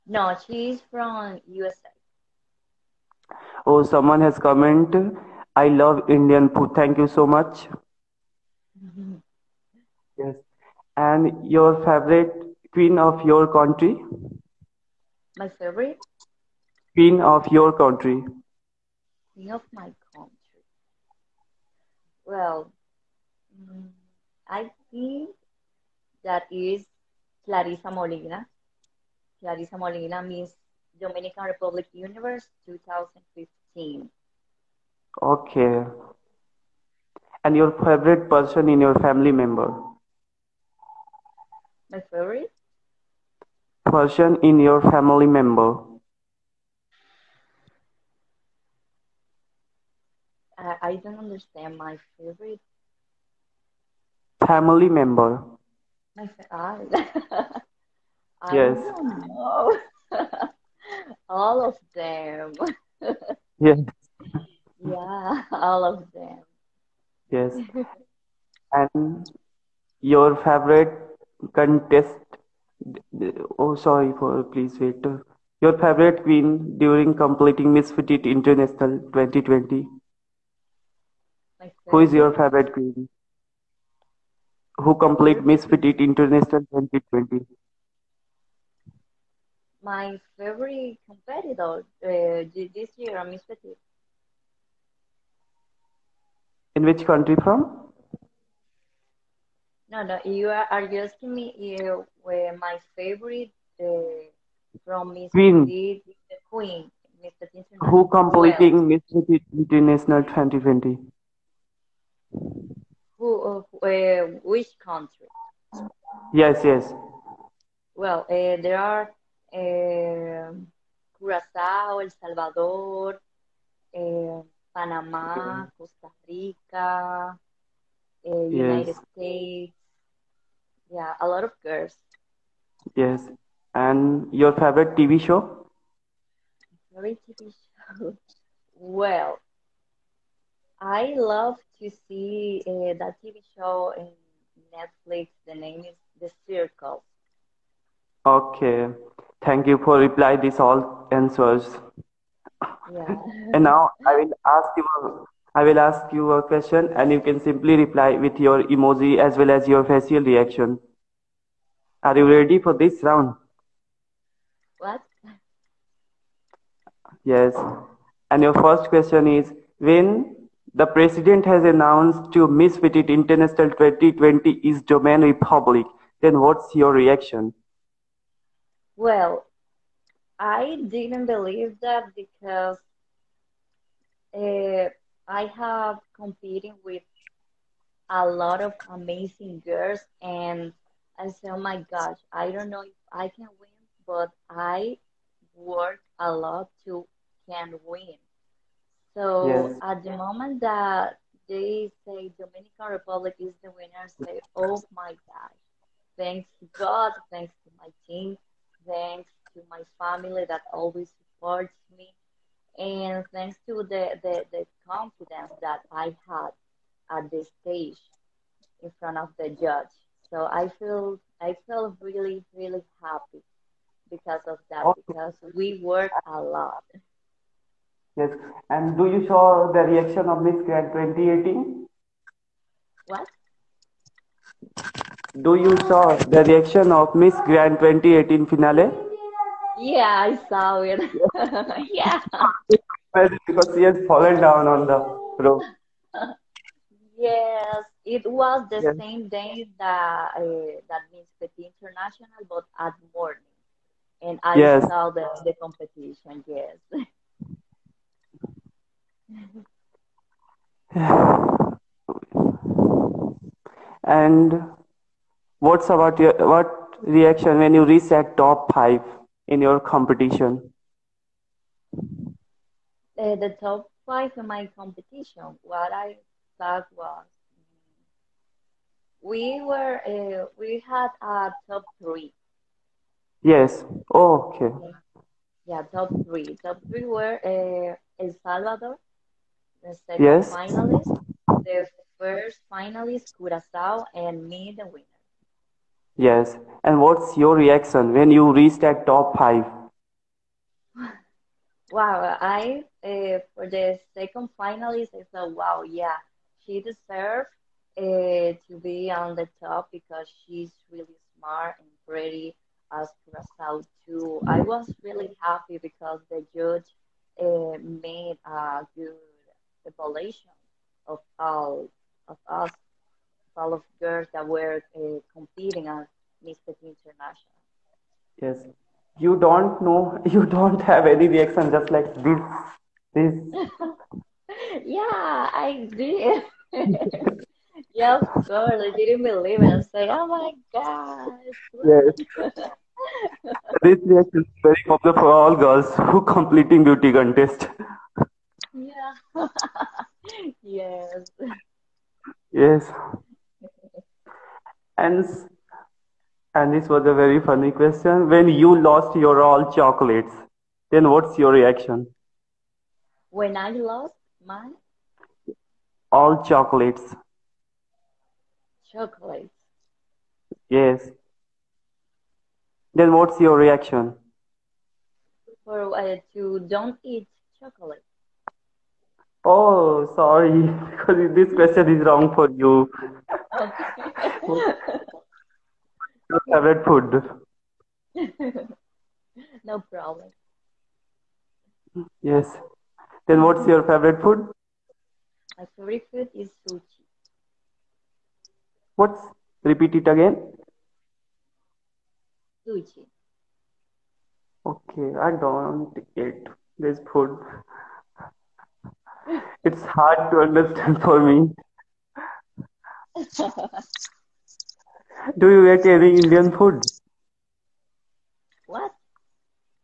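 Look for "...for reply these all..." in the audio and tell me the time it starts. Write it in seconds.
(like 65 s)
149 s.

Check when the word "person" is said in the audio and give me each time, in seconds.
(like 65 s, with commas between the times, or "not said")
38 s, 43 s.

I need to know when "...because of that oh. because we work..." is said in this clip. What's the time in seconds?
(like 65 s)
224 s.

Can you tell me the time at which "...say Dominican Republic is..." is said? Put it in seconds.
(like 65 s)
202 s.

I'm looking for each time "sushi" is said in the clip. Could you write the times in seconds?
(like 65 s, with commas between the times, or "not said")
396 s, 402 s.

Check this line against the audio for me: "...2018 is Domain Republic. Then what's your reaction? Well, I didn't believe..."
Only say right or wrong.
wrong.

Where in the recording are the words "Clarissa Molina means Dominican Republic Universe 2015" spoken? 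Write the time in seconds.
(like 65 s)
29 s.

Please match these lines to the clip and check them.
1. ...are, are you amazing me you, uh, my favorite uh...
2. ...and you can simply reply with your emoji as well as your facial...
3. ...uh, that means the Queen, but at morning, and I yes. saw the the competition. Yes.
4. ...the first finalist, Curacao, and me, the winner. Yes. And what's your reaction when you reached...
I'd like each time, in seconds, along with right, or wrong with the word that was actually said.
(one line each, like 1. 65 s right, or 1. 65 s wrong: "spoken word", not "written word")
1. 100 s wrong: "asking", not "amazing"
2. 156 s right
3. 250 s wrong: "International", not "Queen"
4. 291 s right.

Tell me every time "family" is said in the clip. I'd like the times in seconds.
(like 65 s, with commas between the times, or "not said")
38 s, 44 s, 54 s, 209 s.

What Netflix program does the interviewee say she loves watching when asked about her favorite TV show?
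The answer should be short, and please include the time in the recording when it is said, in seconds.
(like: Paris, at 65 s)
The Circle, at 146 s.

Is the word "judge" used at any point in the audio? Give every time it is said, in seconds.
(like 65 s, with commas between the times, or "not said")
219 s, 316 s.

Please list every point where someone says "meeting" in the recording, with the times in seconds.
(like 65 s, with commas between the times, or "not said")
not said.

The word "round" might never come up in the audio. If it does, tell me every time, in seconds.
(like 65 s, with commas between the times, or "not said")
163 s.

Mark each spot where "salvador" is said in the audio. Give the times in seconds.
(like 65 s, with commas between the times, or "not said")
122 s, 288 s.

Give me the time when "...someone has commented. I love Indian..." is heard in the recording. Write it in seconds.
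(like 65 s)
3 s.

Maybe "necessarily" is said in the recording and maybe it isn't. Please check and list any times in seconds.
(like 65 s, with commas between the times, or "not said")
not said.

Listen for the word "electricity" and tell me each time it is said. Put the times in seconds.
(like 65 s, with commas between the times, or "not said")
not said.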